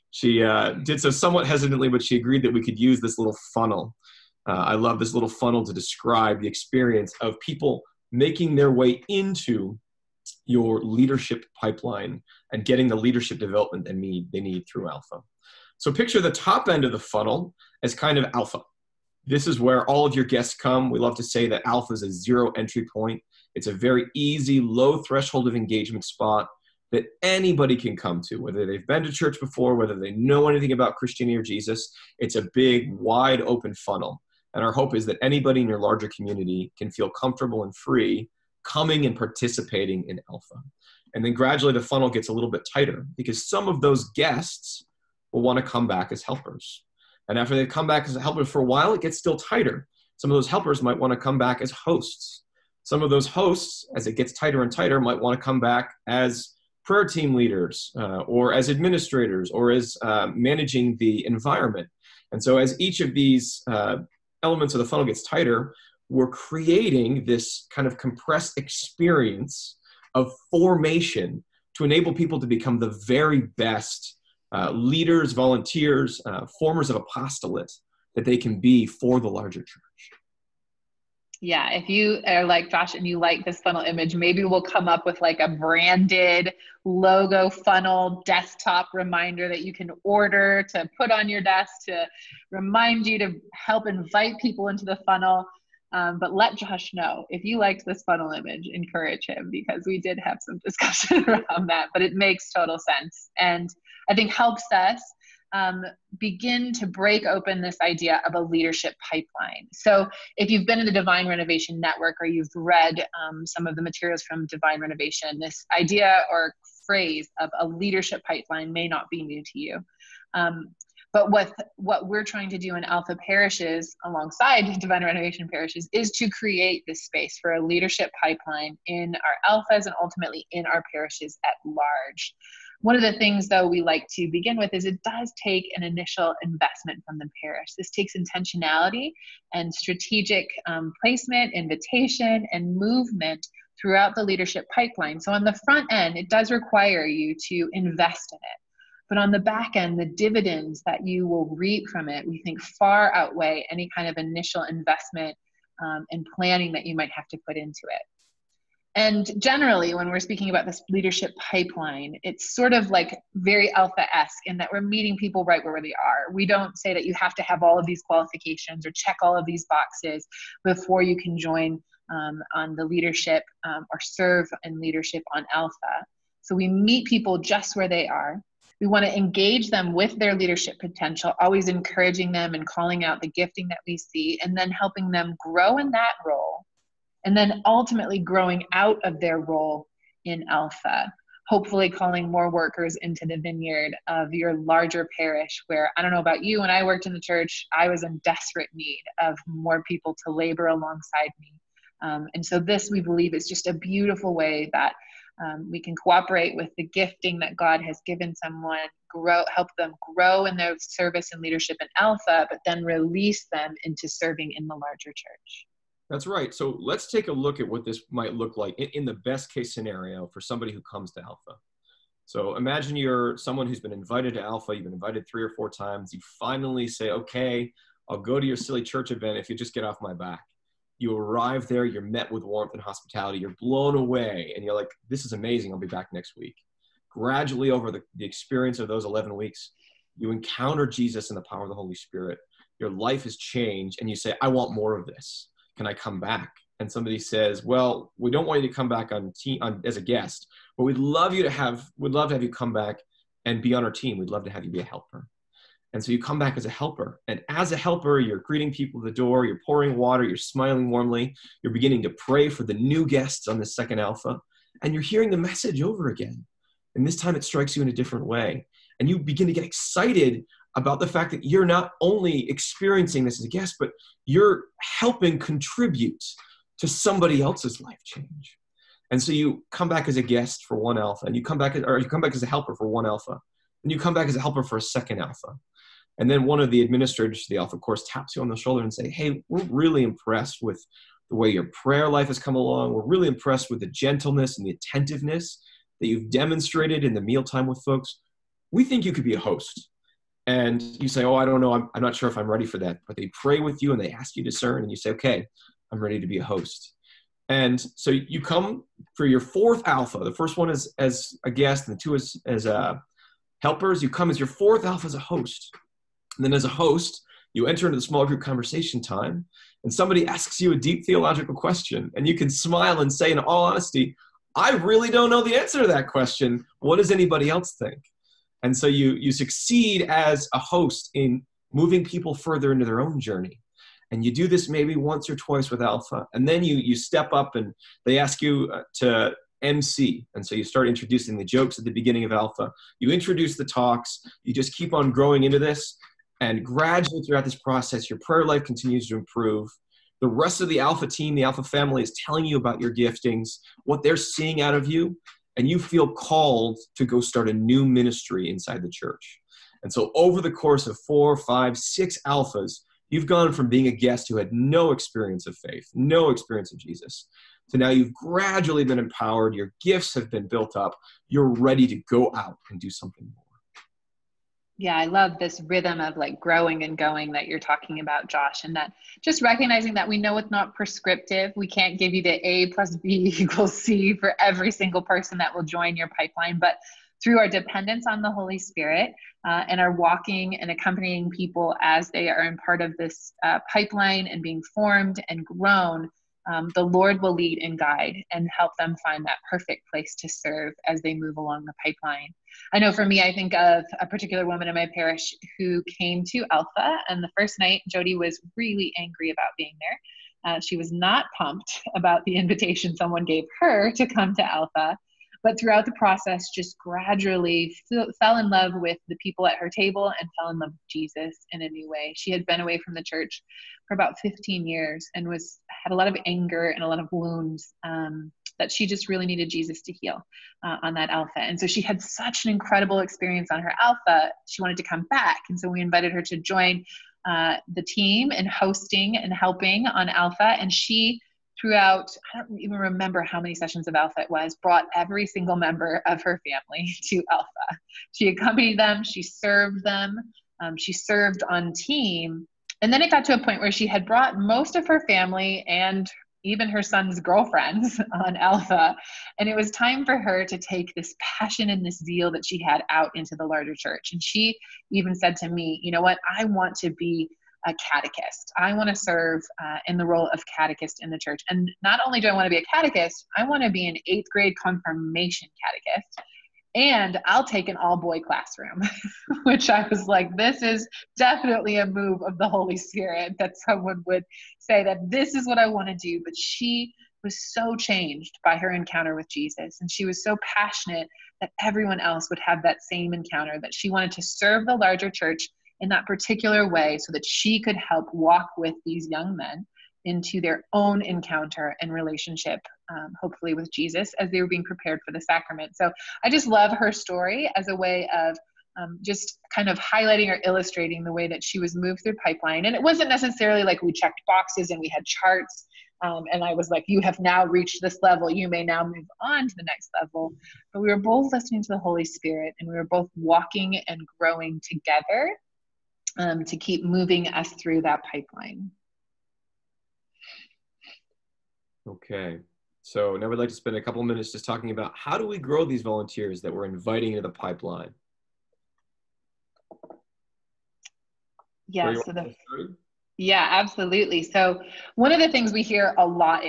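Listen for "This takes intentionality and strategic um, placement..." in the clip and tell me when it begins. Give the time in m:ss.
2:17.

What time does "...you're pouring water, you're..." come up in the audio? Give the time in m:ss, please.
4:19.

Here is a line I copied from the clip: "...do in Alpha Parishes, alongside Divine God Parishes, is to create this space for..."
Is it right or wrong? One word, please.
wrong.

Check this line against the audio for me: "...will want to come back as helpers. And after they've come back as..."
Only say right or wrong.
right.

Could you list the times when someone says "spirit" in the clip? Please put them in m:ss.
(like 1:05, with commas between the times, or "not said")
4:01, 6:28, 8:02, 8:42.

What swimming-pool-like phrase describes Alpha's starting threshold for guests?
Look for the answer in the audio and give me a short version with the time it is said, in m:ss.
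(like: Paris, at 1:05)
Zero entry point, at 0:22.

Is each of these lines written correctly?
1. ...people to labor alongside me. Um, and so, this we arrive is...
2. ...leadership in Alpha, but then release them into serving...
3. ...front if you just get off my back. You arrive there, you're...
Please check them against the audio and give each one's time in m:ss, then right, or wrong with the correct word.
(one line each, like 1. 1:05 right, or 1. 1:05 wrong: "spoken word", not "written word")
1. 3:19 wrong: "believe", not "arrive"
2. 3:31 right
3. 3:49 wrong: "event", not "front".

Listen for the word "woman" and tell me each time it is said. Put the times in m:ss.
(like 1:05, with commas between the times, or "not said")
6:44.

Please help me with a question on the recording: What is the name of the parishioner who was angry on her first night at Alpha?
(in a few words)
Jody.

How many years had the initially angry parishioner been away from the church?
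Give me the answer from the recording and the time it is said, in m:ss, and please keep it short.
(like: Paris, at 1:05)
15, at 7:04.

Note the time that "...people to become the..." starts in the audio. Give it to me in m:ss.
1:12.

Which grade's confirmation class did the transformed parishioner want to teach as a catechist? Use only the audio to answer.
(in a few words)
Eighth grade.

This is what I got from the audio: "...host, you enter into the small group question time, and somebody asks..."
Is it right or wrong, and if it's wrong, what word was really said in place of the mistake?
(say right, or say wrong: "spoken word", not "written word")
wrong: "conversation", not "question".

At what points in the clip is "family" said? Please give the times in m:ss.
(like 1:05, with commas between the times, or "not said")
5:51, 7:26, 7:35.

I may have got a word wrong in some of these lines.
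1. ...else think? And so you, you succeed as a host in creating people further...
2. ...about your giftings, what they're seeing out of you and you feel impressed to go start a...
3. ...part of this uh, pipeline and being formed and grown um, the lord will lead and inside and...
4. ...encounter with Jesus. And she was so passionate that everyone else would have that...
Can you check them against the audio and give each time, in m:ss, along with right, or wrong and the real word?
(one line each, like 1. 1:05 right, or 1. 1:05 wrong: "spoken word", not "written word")
1. 5:27 wrong: "moving", not "creating"
2. 5:52 wrong: "called", not "impressed"
3. 6:32 wrong: "guide", not "inside"
4. 8:08 right.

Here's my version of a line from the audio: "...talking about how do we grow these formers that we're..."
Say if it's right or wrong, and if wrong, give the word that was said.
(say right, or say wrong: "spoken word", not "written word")
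wrong: "volunteers", not "formers".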